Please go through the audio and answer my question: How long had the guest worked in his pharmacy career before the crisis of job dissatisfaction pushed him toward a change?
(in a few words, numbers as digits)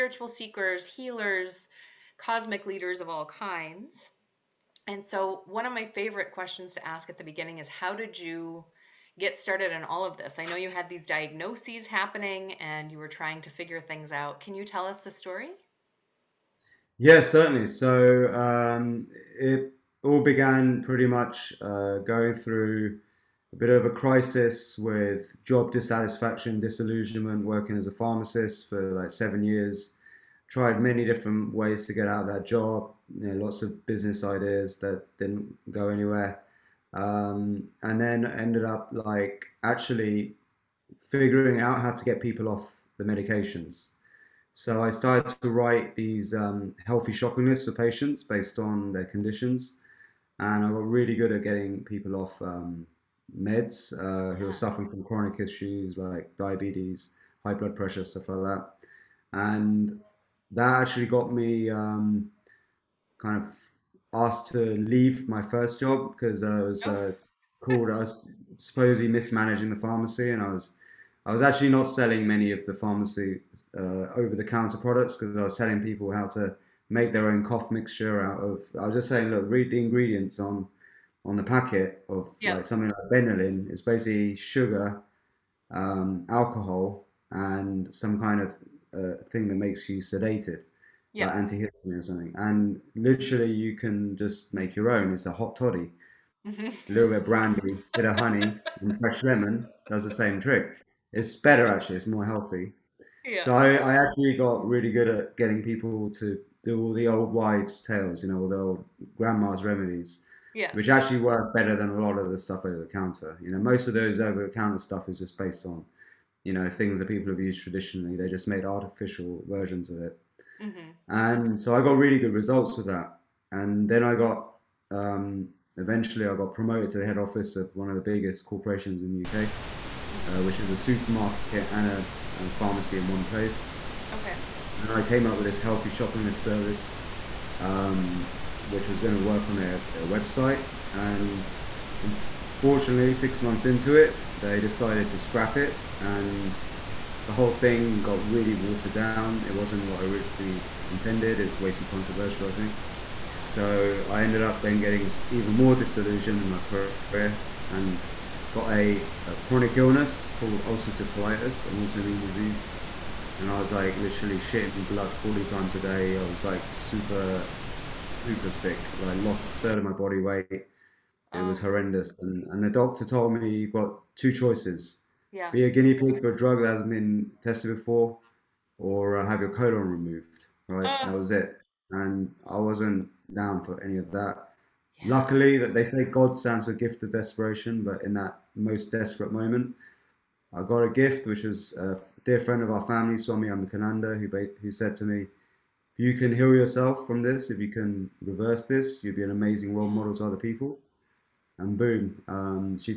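7 years.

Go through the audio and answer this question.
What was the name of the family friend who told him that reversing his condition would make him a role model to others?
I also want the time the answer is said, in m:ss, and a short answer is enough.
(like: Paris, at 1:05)
Swami Ambikananda, at 3:13.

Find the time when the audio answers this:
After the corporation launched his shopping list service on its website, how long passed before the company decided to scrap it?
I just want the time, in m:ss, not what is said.
2:23.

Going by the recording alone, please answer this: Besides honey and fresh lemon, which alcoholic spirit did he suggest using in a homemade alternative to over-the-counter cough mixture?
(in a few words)
brandy.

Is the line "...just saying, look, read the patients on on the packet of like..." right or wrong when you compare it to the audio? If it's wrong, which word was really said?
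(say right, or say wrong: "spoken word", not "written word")
wrong: "ingredients", not "patients".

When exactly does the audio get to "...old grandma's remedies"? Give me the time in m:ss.
1:48.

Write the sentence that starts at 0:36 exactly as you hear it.
Um, and then ended up like actually figuring out how to get people off the medications.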